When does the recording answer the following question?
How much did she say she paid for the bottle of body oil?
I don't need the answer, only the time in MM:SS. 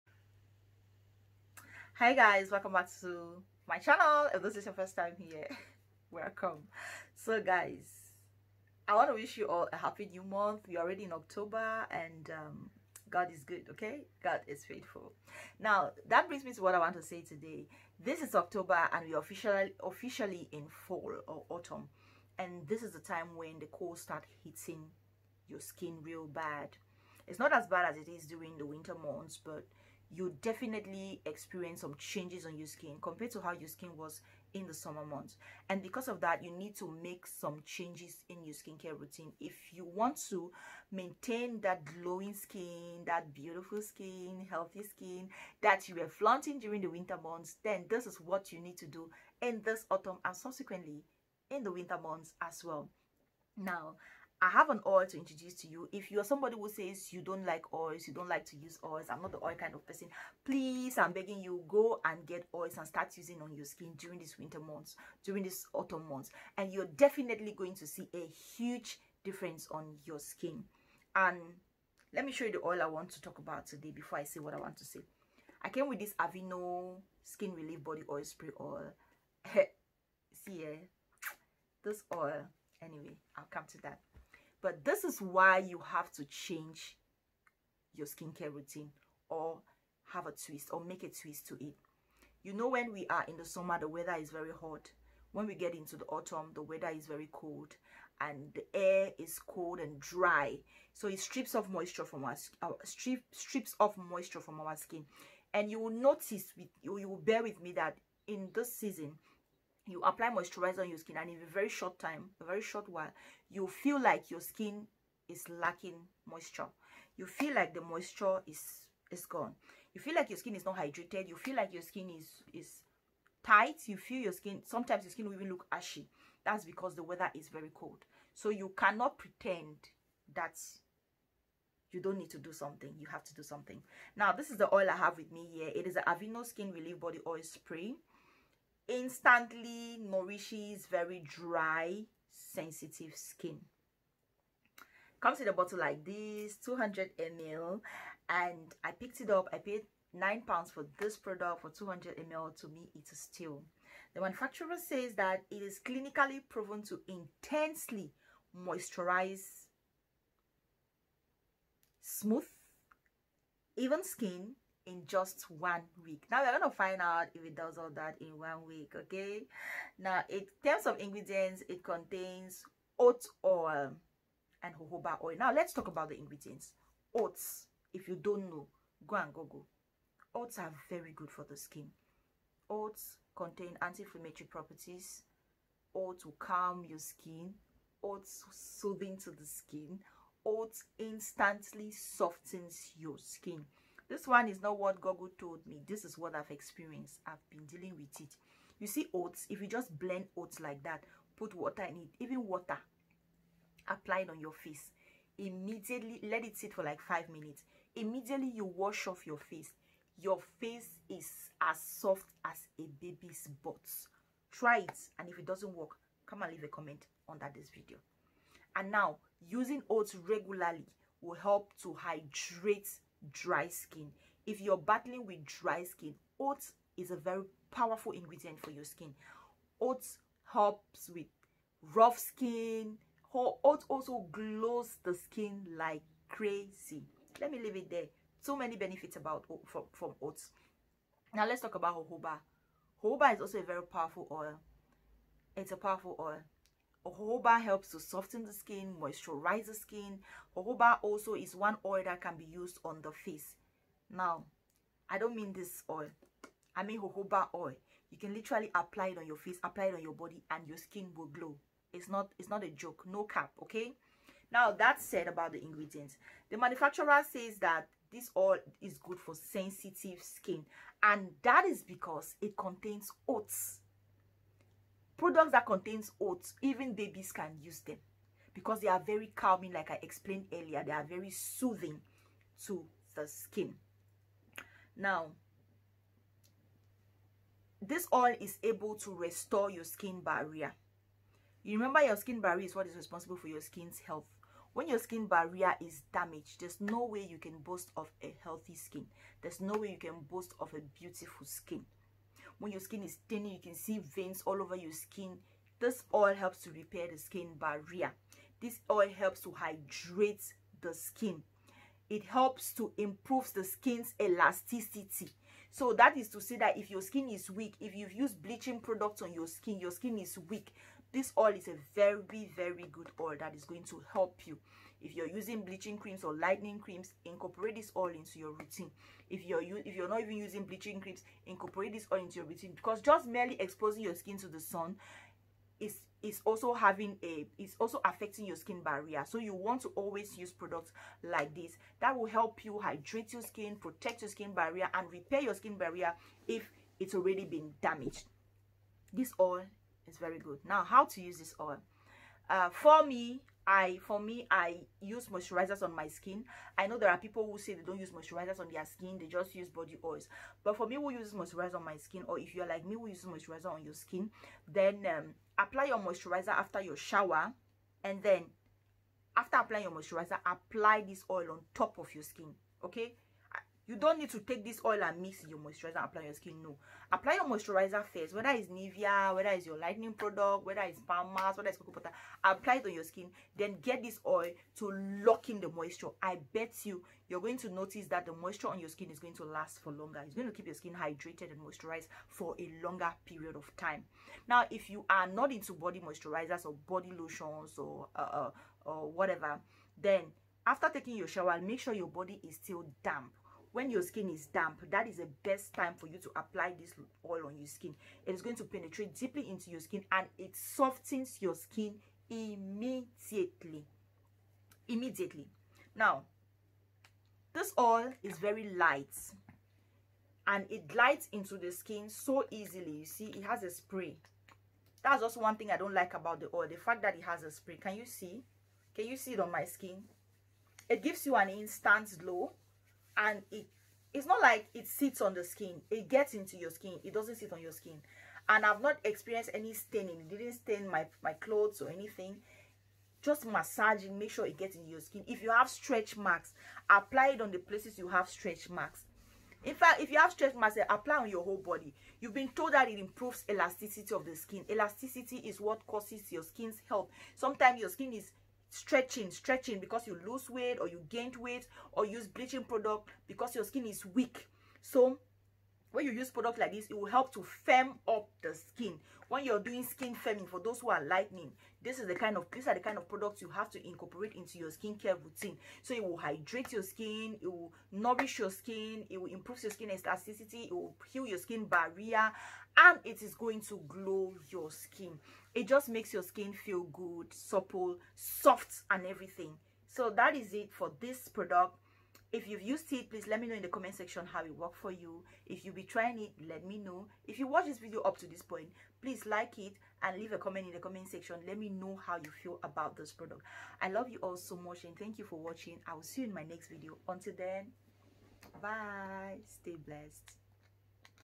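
02:30.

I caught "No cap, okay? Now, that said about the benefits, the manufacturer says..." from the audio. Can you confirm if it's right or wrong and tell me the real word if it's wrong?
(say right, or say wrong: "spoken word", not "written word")
wrong: "ingredients", not "benefits".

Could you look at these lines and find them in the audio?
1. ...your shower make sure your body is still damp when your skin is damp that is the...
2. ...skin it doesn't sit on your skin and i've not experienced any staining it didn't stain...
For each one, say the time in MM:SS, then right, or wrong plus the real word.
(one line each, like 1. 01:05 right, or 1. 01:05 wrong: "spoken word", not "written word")
1. 06:41 right
2. 07:16 right.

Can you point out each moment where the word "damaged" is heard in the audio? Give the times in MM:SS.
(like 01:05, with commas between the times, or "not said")
04:56, 05:47.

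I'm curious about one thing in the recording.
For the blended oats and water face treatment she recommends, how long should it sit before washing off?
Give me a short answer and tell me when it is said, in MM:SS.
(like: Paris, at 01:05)
Five minutes, at 03:26.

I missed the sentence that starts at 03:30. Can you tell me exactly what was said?
Your face is as soft as a baby's butt.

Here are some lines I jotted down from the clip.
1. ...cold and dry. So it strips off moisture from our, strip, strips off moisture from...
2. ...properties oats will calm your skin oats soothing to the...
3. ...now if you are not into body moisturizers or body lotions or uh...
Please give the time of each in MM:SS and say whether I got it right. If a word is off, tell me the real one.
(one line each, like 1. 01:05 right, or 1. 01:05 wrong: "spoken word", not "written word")
1. 01:39 right
2. 03:04 right
3. 06:34 right.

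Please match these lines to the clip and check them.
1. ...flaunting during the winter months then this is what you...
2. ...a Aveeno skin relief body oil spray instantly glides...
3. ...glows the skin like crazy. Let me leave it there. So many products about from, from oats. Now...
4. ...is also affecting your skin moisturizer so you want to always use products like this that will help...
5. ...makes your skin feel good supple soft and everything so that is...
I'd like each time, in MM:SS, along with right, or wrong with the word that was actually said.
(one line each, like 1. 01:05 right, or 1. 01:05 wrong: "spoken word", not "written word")
1. 00:46 right
2. 02:15 wrong: "nourishes", not "glides"
3. 03:54 wrong: "benefits", not "products"
4. 05:37 wrong: "barrier", not "moisturizer"
5. 08:05 right.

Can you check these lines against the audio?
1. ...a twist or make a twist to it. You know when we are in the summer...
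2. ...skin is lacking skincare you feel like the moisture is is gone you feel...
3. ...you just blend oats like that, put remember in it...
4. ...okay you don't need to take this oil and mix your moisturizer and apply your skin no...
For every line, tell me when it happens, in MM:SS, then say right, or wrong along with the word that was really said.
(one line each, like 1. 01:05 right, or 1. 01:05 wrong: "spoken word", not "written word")
1. 01:30 right
2. 01:54 wrong: "moisture", not "skincare"
3. 03:19 wrong: "water", not "remember"
4. 06:12 right.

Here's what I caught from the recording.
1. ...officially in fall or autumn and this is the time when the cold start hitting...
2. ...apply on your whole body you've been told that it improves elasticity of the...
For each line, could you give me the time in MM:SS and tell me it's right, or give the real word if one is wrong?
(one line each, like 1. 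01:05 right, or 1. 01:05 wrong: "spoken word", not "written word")
1. 00:19 right
2. 07:30 right.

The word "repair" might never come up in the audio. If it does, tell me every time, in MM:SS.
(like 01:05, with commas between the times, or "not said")
05:06, 05:45.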